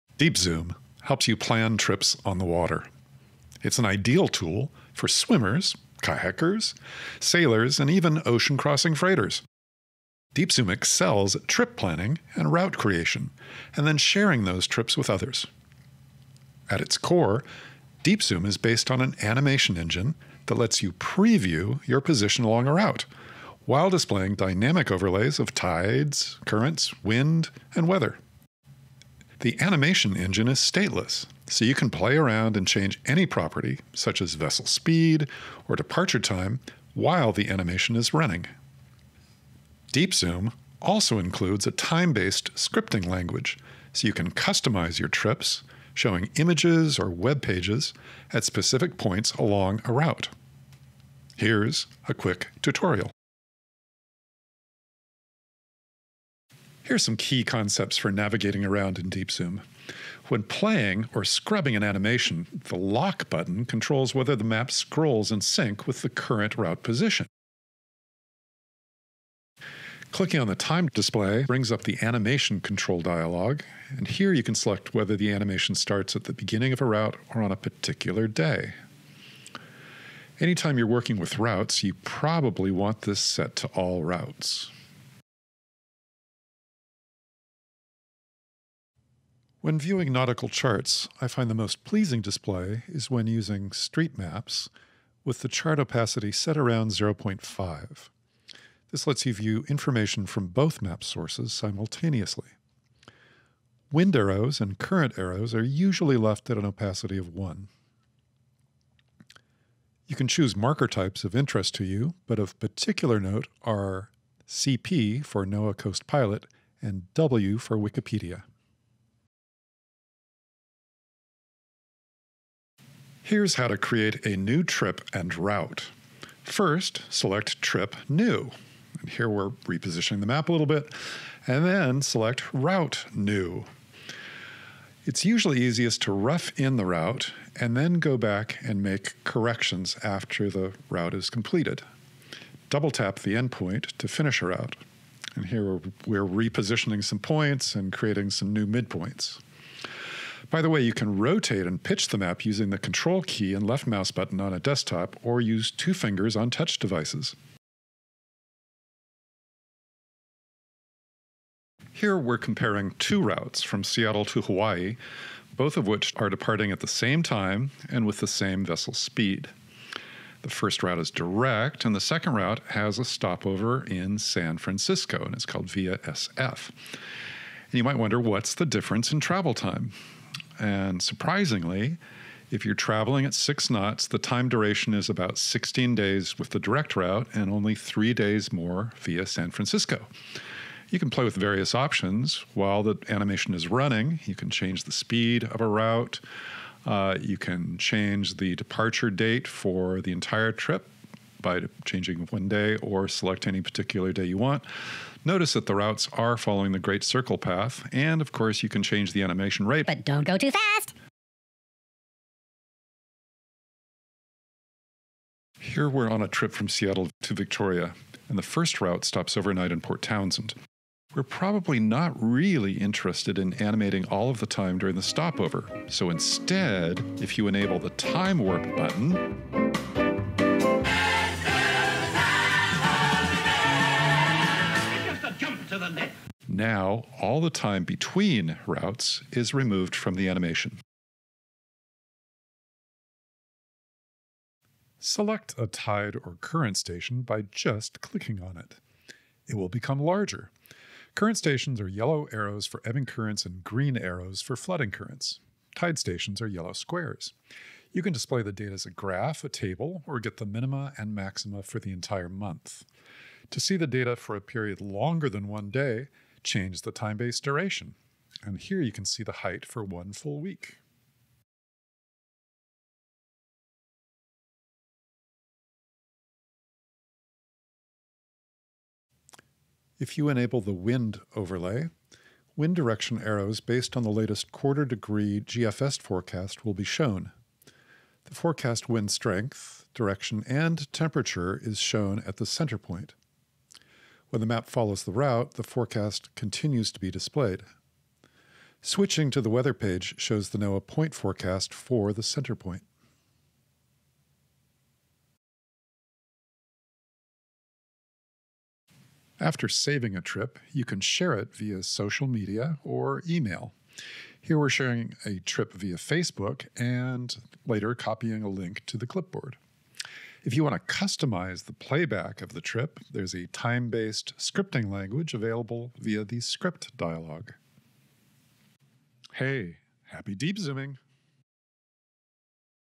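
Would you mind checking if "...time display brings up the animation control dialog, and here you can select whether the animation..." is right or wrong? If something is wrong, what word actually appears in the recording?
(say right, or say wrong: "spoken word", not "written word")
right.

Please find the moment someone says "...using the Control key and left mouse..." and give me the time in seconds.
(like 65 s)
152 s.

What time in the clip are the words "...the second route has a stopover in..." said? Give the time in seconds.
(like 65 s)
171 s.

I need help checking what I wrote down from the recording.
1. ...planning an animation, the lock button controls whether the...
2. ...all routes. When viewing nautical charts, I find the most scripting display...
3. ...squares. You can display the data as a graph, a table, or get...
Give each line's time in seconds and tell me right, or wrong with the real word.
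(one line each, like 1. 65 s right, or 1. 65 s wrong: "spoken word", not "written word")
1. 61 s wrong: "scrubbing", not "planning"
2. 83 s wrong: "pleasing", not "scripting"
3. 256 s right.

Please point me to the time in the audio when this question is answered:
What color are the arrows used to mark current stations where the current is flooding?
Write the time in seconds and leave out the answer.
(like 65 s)
253 s.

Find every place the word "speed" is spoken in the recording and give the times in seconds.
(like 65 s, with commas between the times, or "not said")
34 s, 168 s, 194 s.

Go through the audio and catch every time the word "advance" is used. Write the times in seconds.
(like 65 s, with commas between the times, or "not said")
not said.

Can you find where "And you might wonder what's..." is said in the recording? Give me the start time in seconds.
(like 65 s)
176 s.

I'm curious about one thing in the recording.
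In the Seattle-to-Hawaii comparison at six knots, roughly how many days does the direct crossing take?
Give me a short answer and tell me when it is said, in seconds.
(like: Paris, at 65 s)
16 days, at 185 s.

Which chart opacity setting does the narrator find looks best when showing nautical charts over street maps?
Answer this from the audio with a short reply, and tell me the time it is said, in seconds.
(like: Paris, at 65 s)
0.5, at 96 s.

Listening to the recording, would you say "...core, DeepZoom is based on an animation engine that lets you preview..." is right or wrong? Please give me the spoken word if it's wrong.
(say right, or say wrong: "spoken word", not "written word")
right.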